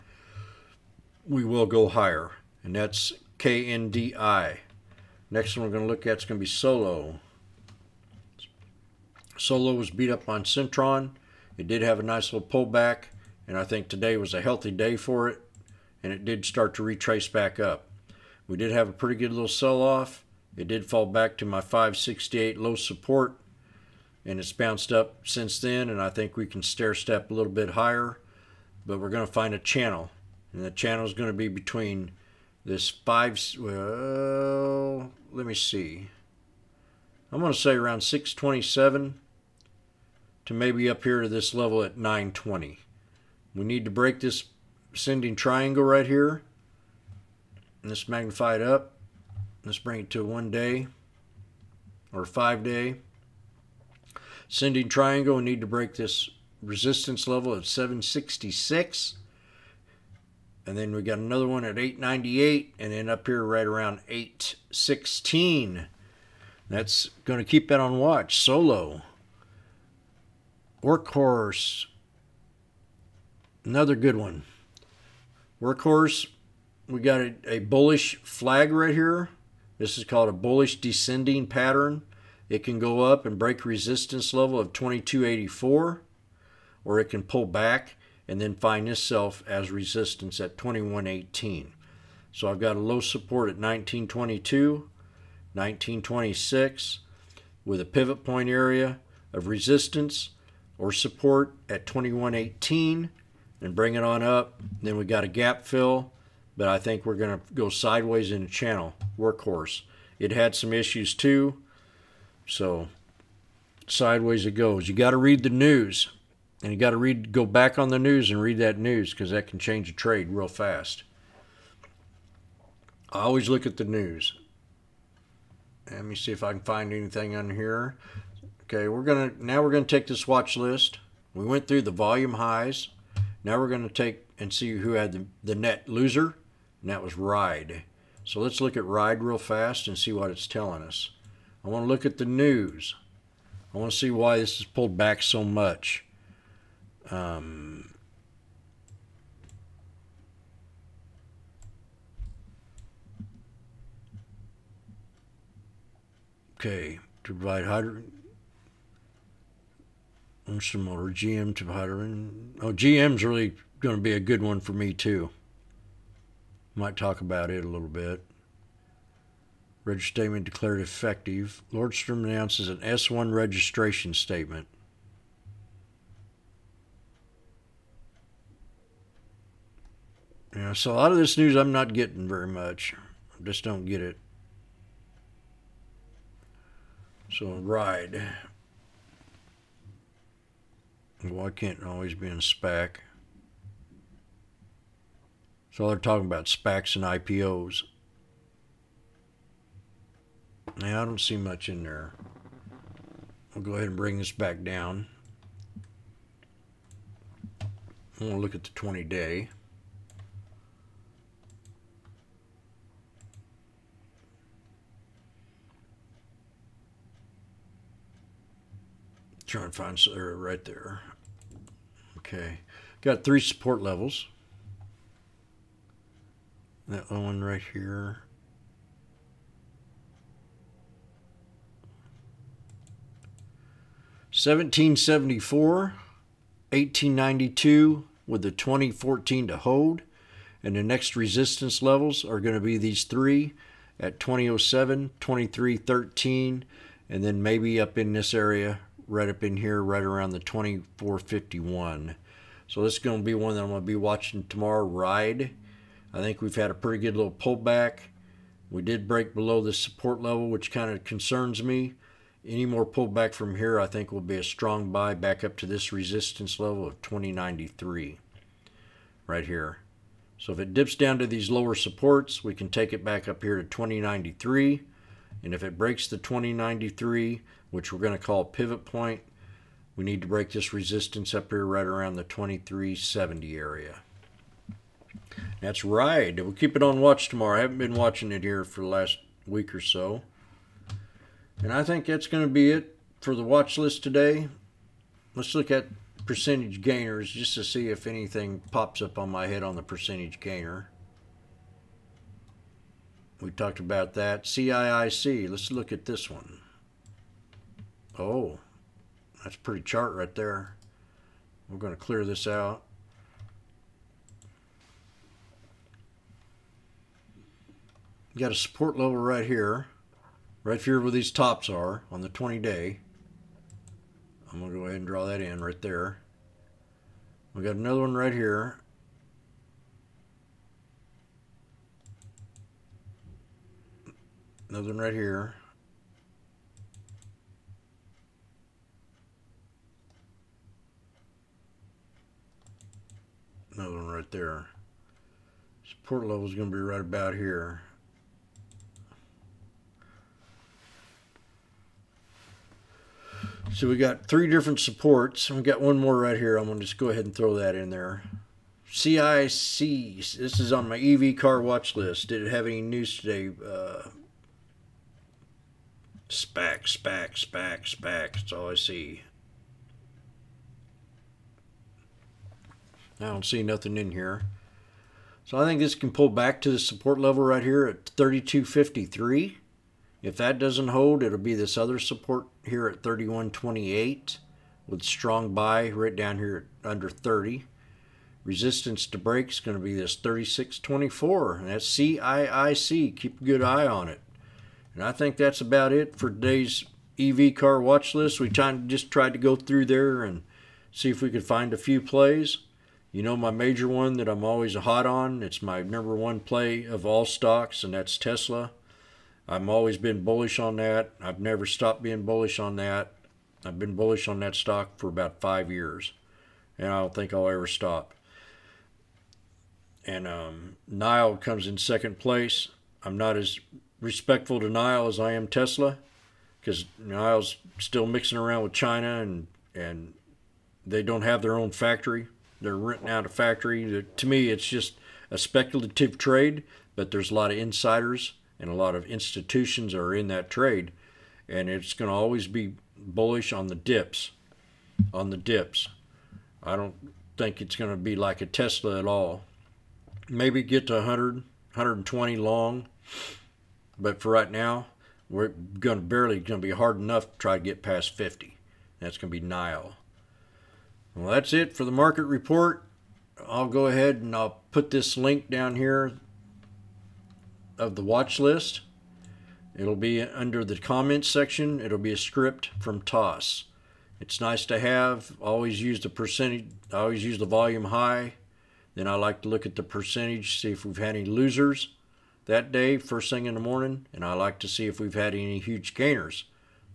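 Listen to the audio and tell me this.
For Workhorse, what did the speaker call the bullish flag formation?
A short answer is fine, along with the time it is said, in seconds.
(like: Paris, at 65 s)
bullish descending pattern, at 80 s.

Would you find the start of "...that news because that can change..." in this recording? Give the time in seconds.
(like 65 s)
118 s.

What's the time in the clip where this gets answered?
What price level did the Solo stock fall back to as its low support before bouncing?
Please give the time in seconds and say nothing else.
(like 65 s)
21 s.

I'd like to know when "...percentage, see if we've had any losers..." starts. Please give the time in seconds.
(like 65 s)
479 s.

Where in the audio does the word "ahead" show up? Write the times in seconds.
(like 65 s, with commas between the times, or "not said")
203 s, 324 s, 357 s, 463 s.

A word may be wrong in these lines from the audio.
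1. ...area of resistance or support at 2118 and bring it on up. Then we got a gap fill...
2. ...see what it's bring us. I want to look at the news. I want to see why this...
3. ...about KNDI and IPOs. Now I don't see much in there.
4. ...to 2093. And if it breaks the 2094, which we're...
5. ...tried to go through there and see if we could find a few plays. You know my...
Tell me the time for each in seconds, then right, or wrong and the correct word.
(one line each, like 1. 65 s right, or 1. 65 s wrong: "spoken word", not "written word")
1. 98 s right
2. 139 s wrong: "telling", not "bring"
3. 196 s wrong: "SPACs", not "KNDI"
4. 273 s wrong: "2093", not "2094"
5. 399 s right.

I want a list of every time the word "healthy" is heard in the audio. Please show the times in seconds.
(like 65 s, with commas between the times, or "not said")
14 s.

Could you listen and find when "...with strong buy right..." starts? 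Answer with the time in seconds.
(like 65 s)
384 s.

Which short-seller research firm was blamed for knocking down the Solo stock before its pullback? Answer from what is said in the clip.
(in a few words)
Citron.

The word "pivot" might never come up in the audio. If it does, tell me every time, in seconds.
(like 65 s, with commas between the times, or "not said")
97 s, 278 s.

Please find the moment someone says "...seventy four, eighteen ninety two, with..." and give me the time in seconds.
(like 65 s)
234 s.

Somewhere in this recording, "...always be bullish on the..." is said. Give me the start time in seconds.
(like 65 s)
442 s.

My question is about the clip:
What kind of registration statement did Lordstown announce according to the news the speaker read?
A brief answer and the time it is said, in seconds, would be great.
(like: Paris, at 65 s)
S1, at 172 s.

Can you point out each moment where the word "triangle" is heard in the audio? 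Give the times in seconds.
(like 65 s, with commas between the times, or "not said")
45 s, 54 s.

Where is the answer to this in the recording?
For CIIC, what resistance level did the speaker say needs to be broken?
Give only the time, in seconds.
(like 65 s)
390 s.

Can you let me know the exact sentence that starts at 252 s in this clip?
So this is going to be one that I'm going to be watching tomorrow, Ride.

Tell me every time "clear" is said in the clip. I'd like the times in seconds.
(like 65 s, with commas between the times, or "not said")
311 s.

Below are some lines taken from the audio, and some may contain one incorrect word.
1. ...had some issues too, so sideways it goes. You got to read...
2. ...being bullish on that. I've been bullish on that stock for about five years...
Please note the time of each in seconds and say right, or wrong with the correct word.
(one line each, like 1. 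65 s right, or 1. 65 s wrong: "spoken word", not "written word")
1. 110 s right
2. 412 s right.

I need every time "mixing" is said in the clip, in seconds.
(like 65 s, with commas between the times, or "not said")
428 s.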